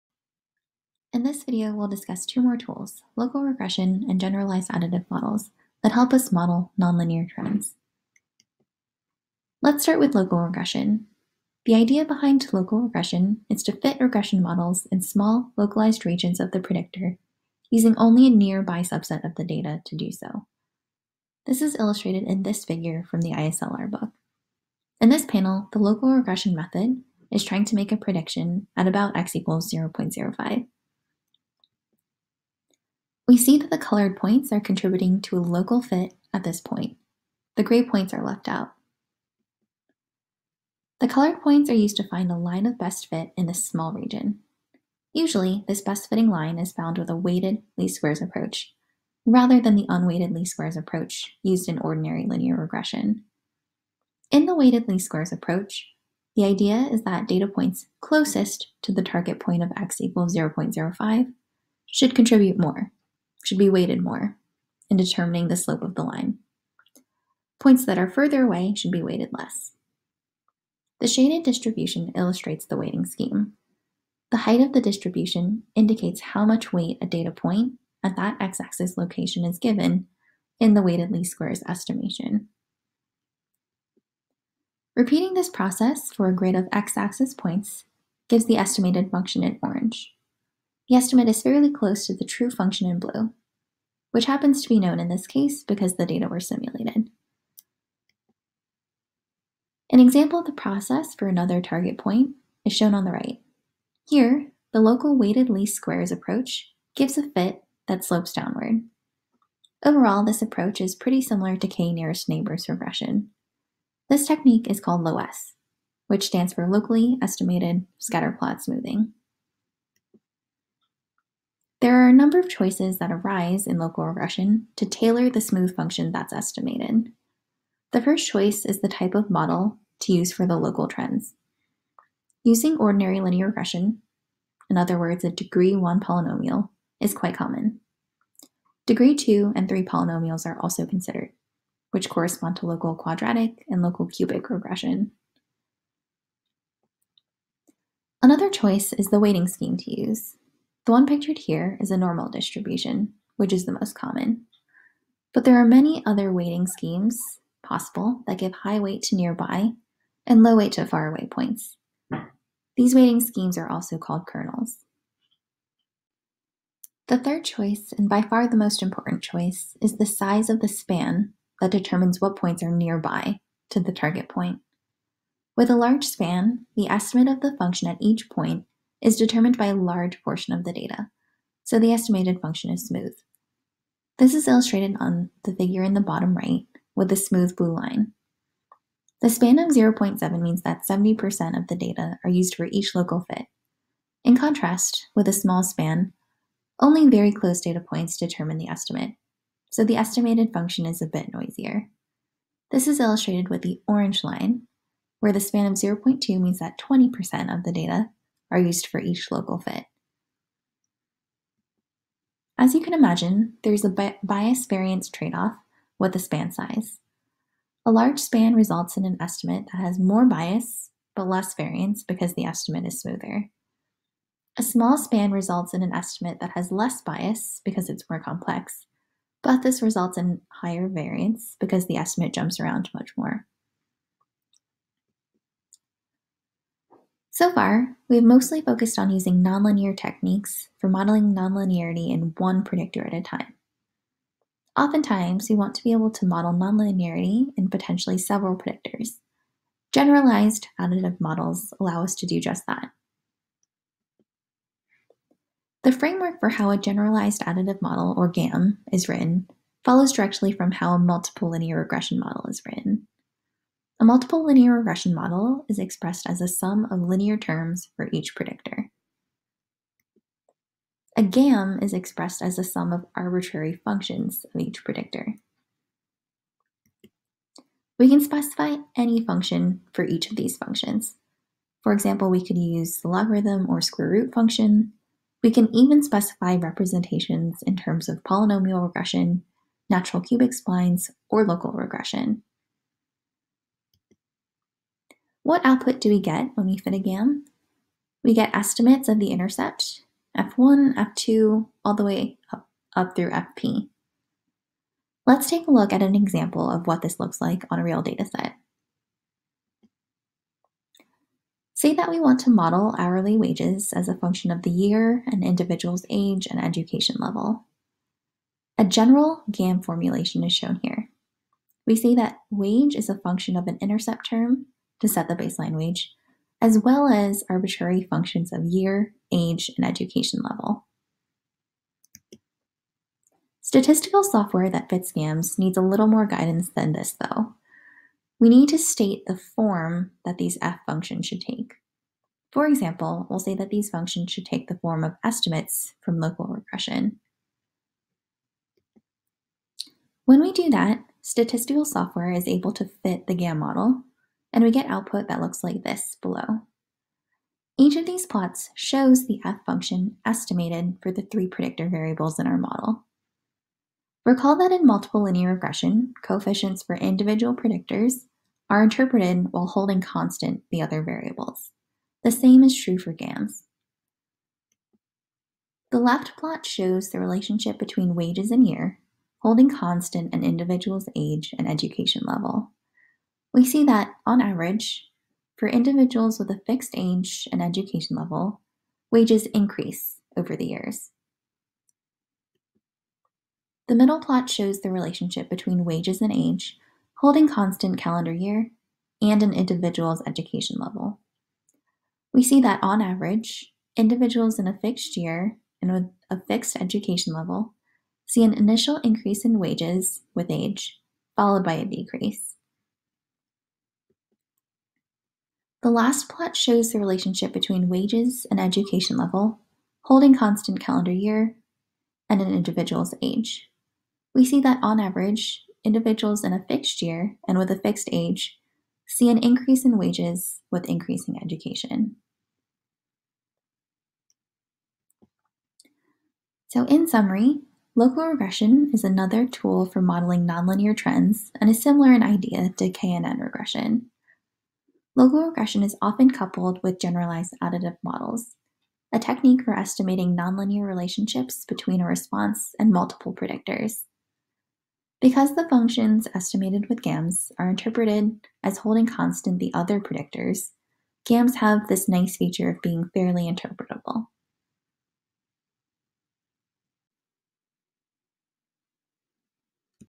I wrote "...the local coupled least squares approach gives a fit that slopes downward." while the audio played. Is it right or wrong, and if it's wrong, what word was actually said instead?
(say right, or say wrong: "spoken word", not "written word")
wrong: "weighted", not "coupled".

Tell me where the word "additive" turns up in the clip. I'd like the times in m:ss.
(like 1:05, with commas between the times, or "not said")
0:04, 4:10, 4:17, 7:27.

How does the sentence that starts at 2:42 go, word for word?
These weighting schemes are also called kernels.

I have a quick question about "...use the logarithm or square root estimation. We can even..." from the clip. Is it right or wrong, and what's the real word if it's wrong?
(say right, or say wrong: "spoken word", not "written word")
wrong: "function", not "estimation".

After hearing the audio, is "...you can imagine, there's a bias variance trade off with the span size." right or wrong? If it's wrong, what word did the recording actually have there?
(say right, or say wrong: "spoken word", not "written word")
right.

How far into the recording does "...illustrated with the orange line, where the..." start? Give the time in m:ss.
3:22.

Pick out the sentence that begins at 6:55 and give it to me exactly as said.
The last plot shows the relationship between wages and education level, holding constant calendar year, and an individual's age.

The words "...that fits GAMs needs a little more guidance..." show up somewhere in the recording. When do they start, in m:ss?
5:34.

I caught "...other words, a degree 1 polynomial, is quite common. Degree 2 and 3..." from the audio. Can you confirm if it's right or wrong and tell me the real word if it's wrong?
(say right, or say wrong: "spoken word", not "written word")
right.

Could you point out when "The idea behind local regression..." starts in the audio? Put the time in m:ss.
0:11.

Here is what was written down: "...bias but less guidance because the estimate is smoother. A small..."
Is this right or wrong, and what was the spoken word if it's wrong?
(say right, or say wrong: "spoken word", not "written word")
wrong: "variance", not "guidance".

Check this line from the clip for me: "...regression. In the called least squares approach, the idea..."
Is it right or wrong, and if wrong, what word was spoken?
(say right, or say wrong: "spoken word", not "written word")
wrong: "weighted", not "called".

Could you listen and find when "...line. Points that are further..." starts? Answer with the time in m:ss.
1:06.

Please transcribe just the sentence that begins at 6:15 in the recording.
The left plot shows the relationship between wages and year, holding constant an individual's age and education level.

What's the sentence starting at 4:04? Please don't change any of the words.
Oftentimes, we want to be able to model nonlinearity in potentially several predictors.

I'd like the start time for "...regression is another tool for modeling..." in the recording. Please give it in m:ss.
7:18.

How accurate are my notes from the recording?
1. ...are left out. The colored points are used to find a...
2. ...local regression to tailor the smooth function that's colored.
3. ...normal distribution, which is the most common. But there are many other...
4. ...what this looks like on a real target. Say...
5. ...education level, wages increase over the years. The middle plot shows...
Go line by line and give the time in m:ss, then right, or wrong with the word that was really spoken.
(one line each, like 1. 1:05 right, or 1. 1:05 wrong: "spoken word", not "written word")
1. 0:38 right
2. 2:03 wrong: "estimated", not "colored"
3. 2:31 right
4. 5:06 wrong: "dataset", not "target"
5. 6:27 right.